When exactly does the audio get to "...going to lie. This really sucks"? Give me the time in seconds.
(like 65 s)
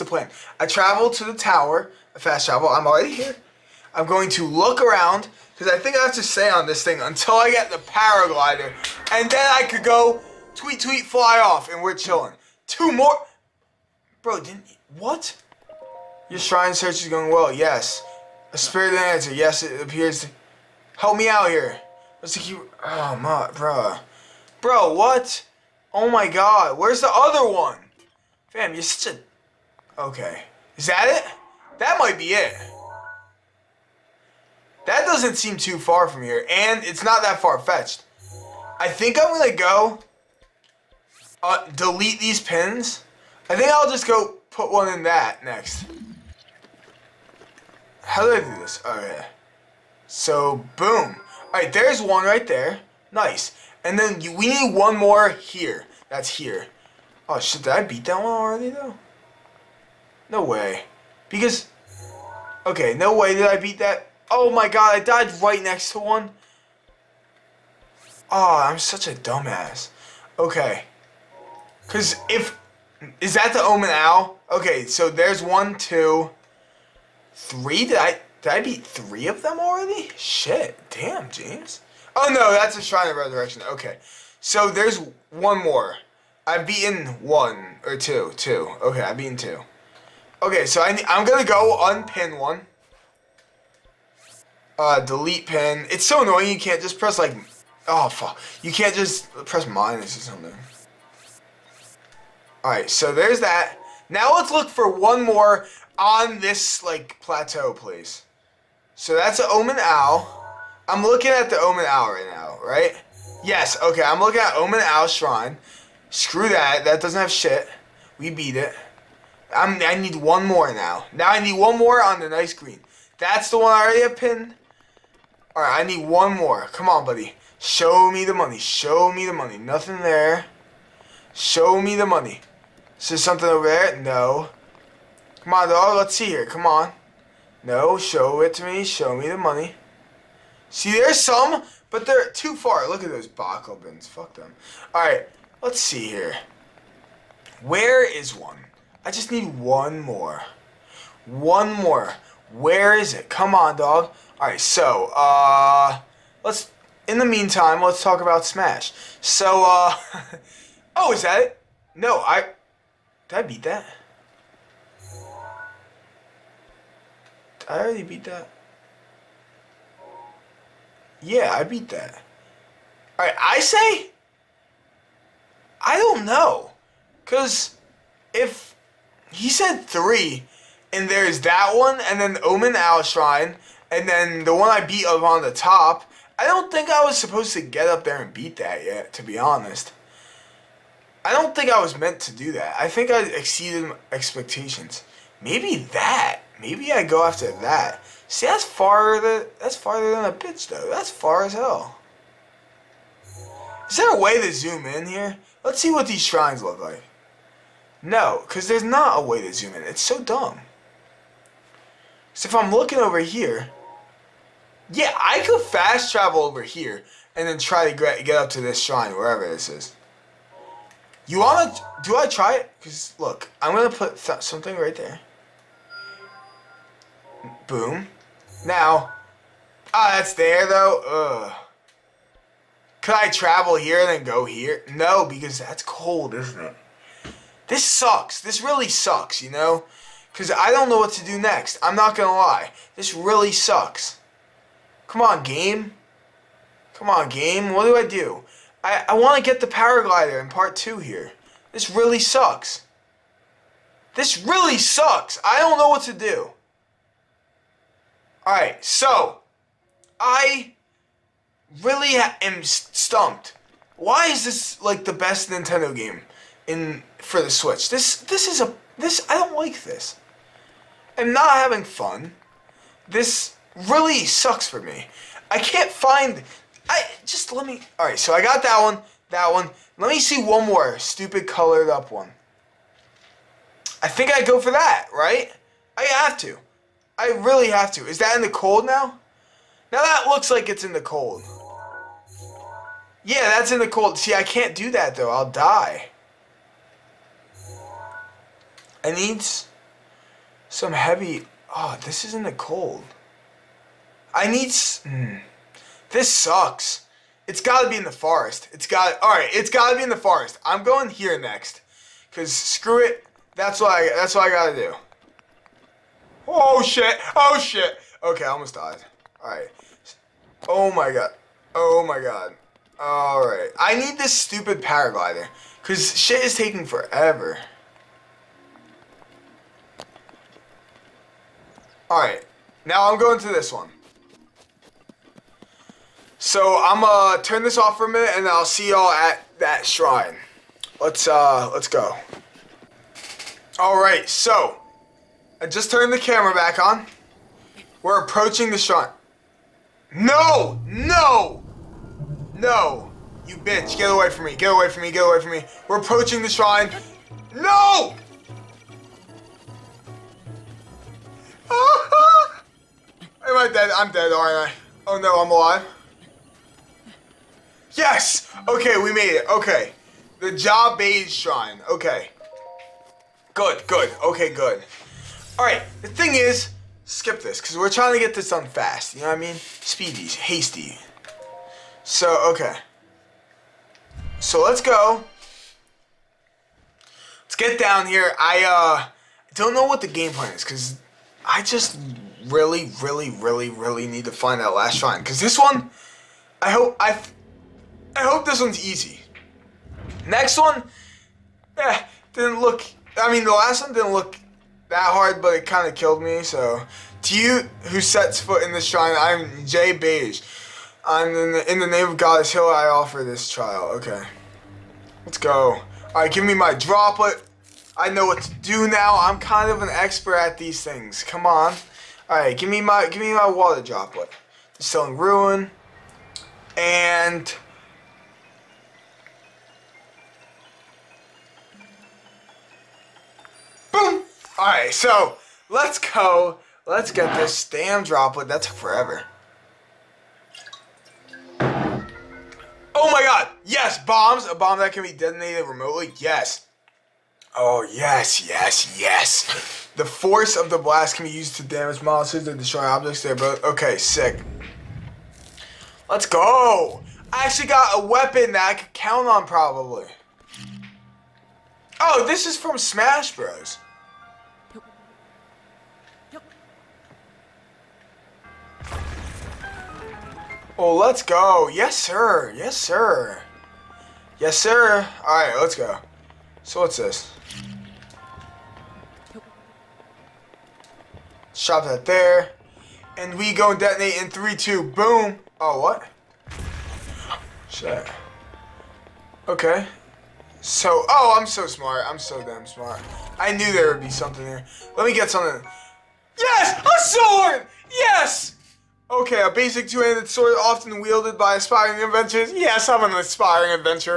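242 s.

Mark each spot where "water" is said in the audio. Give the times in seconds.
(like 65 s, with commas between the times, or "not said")
423 s.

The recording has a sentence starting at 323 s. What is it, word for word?
I need this stupid paraglider, cause shit is taking forever.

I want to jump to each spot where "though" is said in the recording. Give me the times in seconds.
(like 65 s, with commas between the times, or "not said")
58 s, 200 s, 230 s, 295 s.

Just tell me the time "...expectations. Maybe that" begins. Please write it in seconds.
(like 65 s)
194 s.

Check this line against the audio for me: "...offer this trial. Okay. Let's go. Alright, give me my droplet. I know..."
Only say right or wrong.
right.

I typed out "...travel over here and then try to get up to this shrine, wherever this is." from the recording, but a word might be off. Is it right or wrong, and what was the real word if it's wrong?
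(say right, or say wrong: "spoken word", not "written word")
right.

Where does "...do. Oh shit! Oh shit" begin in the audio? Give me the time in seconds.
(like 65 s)
314 s.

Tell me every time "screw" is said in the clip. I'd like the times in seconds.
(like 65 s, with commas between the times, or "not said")
116 s, 312 s.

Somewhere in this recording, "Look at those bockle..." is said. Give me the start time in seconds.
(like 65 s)
142 s.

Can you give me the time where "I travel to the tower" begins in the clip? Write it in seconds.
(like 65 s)
0 s.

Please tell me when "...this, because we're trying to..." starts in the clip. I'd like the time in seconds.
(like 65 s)
377 s.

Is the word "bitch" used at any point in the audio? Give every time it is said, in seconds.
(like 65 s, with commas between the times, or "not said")
200 s, 353 s.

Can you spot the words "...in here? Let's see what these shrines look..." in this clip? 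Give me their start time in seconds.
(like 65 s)
204 s.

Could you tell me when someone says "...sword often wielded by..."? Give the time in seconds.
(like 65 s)
500 s.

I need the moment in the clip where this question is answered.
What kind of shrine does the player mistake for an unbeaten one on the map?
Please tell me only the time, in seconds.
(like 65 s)
82 s.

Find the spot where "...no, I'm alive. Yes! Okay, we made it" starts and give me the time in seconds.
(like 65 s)
365 s.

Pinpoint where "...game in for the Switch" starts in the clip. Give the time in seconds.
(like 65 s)
265 s.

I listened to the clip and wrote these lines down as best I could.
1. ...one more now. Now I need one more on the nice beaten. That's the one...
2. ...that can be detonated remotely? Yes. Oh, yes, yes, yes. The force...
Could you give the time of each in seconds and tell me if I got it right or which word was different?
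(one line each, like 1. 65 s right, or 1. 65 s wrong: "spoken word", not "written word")
1. 120 s wrong: "green", not "beaten"
2. 444 s right.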